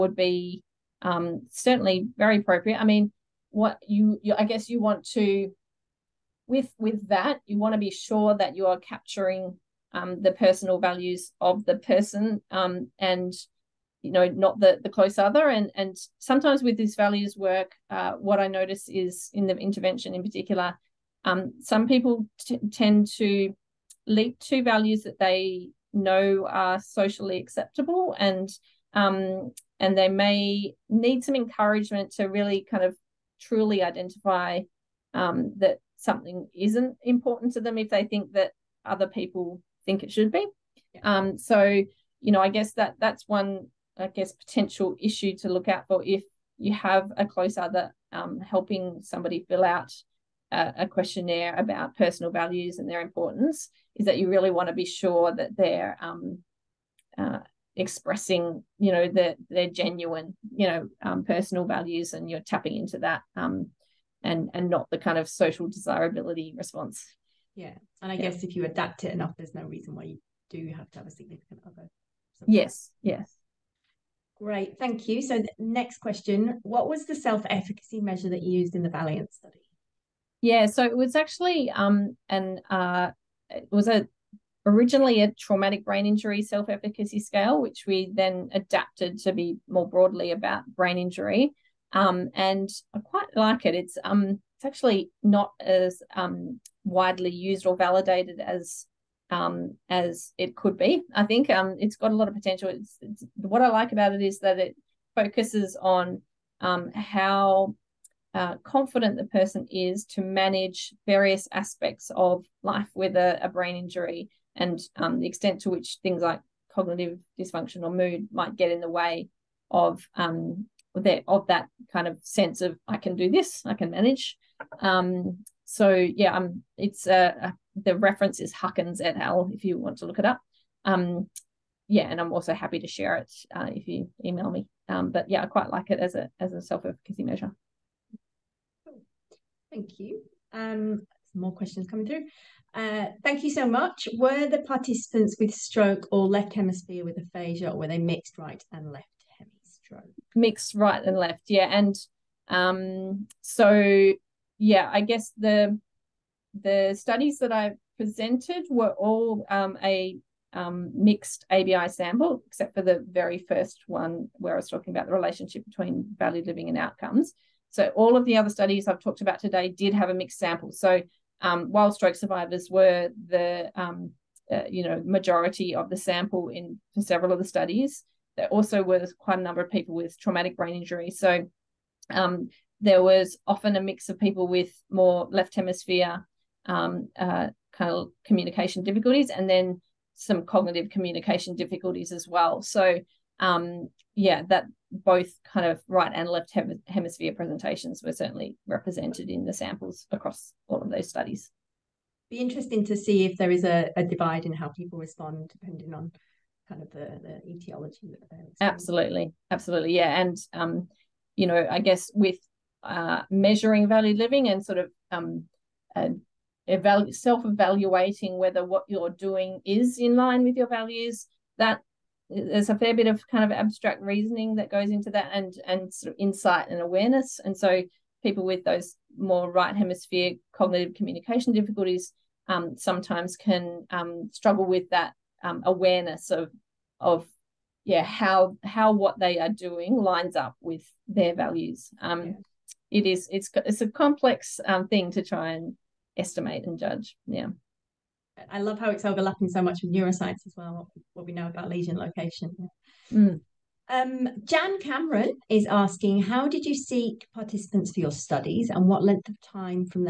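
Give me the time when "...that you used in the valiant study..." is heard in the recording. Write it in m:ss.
1:18.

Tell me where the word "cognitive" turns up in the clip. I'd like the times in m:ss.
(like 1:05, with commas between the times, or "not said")
1:56, 3:10, 3:50.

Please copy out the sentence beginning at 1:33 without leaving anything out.
It's um, it's actually not as um, widely used or validated as um, as it could be.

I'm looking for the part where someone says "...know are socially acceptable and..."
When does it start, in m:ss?
0:25.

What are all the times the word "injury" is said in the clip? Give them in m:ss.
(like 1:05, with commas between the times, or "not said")
1:26, 1:30, 1:53, 3:00.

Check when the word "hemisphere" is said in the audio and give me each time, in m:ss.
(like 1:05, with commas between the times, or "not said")
2:26, 3:05, 3:16, 3:49.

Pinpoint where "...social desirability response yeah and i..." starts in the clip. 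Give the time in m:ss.
1:05.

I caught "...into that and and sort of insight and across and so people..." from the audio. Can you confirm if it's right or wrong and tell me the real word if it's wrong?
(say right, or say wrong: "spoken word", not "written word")
wrong: "awareness", not "across".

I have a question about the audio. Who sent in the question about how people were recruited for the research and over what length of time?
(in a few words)
Jan Cameron.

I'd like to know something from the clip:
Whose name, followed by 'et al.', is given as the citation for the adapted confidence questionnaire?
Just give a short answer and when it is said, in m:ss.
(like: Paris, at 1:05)
Huckins, at 2:08.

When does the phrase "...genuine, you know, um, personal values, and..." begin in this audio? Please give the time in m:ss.
0:59.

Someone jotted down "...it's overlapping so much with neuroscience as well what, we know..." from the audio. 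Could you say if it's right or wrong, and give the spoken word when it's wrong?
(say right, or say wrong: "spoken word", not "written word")
right.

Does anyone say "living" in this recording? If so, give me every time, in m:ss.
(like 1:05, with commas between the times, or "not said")
2:46, 3:34.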